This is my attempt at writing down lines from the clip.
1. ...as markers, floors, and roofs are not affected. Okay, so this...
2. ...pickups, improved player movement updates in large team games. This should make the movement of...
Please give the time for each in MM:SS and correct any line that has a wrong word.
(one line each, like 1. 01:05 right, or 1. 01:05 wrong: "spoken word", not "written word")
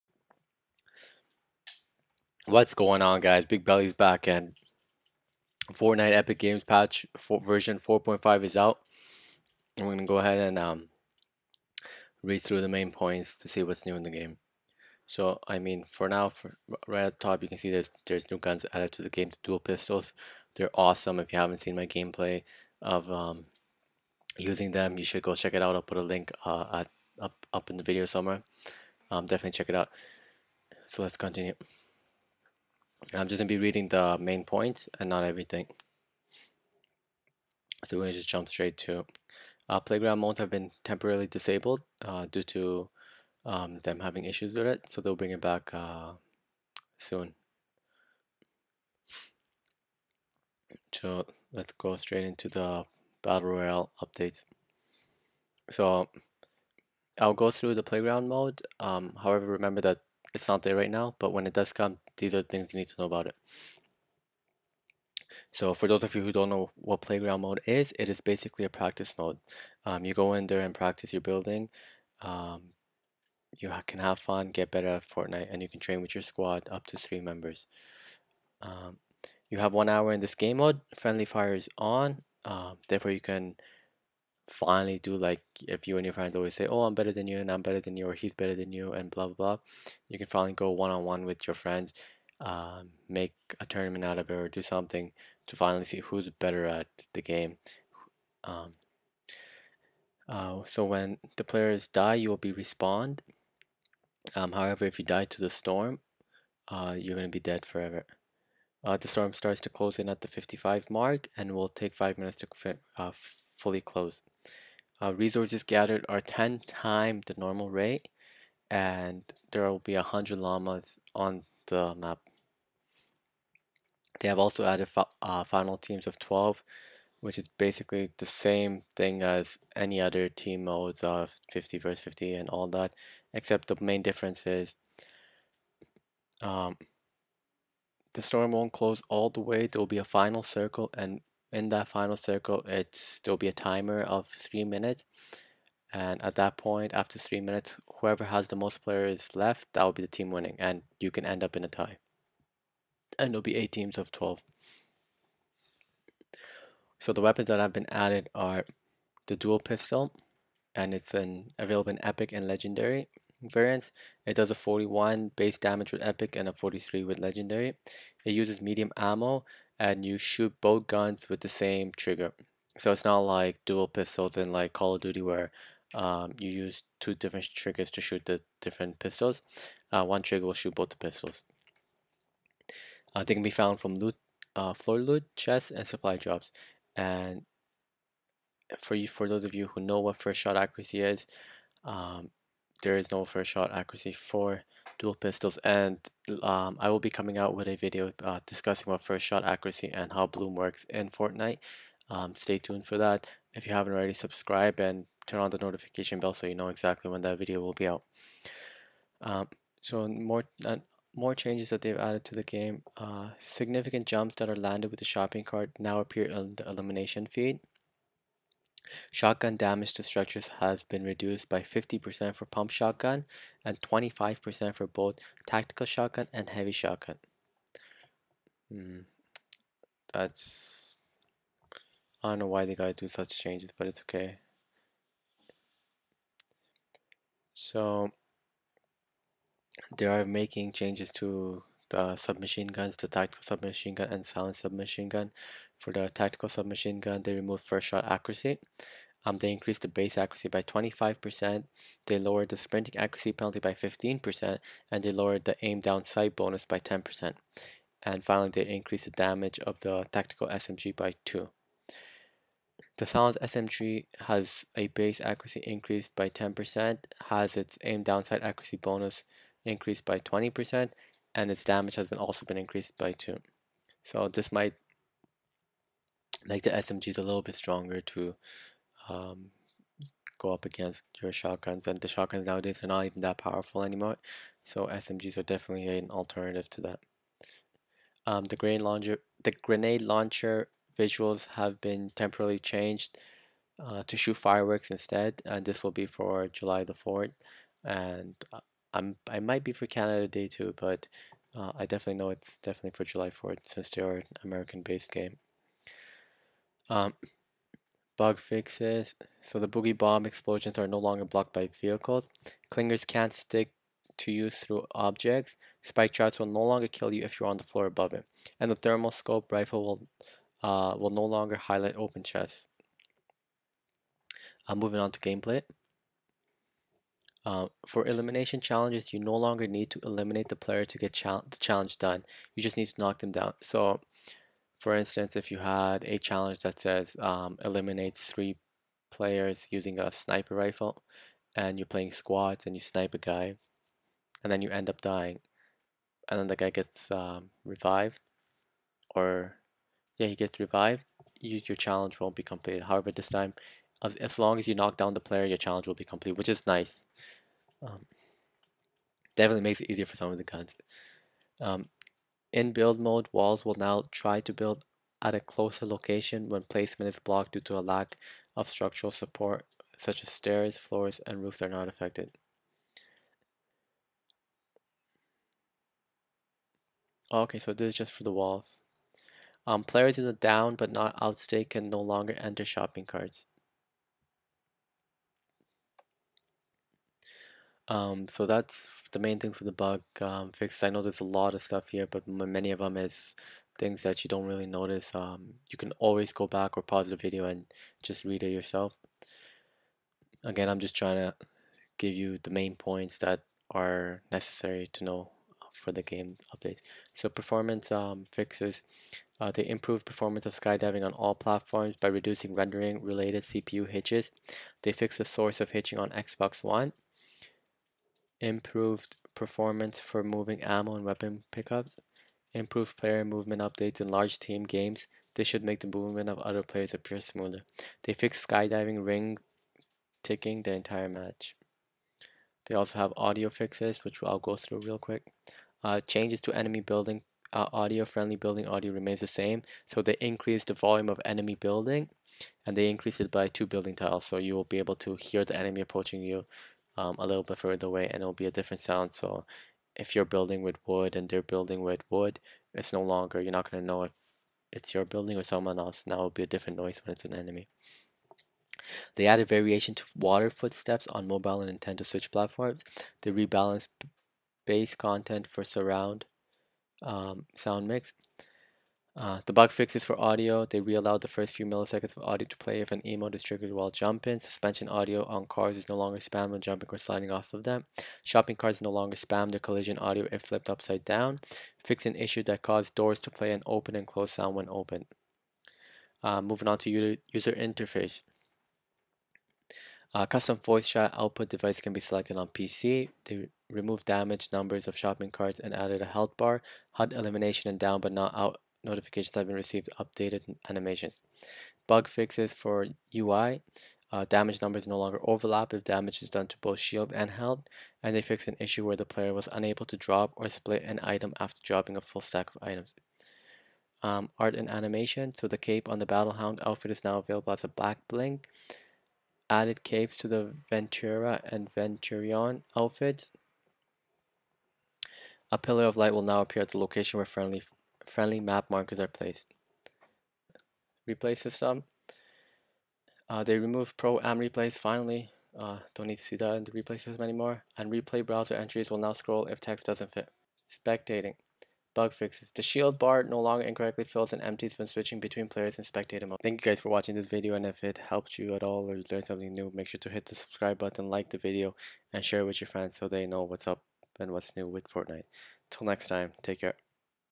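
1. 06:10 wrong: "stairs", not "markers"
2. 07:01 right.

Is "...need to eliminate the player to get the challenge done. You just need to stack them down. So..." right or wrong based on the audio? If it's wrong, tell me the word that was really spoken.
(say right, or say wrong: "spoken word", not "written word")
wrong: "knock", not "stack".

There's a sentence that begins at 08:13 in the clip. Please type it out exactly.
They removed damaged numbers of shopping carts and added a health bar.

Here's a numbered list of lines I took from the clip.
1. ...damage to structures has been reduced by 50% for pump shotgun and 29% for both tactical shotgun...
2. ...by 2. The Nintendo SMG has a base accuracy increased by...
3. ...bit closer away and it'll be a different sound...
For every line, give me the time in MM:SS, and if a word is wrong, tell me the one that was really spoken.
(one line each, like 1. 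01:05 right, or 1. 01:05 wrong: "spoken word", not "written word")
1. 03:39 wrong: "25", not "29"
2. 04:20 wrong: "Silent", not "Nintendo"
3. 07:27 wrong: "further", not "closer".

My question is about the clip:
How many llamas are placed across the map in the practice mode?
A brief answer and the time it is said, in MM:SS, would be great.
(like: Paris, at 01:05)
100, at 01:59.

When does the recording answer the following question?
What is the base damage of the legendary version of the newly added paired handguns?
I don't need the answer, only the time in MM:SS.
02:46.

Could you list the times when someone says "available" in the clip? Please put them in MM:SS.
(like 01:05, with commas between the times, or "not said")
02:41, 08:37.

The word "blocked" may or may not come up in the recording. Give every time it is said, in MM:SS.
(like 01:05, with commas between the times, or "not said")
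05:11, 06:07.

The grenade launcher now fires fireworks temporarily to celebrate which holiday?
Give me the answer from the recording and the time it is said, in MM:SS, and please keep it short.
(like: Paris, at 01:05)
July 4th, at 04:56.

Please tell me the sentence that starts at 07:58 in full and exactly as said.
Shopping carts no longer spam their collision audio if flipped upside down.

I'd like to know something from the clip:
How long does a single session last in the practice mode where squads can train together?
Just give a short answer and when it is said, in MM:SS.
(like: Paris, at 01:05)
1 hour, at 01:19.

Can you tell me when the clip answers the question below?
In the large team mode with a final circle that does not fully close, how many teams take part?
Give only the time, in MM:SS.
02:33.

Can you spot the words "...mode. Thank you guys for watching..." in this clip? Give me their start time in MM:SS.
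09:06.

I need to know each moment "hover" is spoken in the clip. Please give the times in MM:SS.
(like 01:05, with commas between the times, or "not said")
not said.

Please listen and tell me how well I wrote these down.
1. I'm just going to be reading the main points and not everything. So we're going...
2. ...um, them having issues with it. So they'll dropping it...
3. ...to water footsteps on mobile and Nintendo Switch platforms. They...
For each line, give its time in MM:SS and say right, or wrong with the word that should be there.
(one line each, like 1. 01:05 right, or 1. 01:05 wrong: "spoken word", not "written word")
1. 00:33 right
2. 00:43 wrong: "bring", not "dropping"
3. 07:39 right.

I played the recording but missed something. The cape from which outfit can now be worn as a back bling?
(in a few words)
Battlehawk.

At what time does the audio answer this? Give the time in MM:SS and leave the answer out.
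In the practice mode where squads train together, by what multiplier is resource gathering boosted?
01:56.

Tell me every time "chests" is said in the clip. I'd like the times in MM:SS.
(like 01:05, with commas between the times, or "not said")
03:05, 05:22.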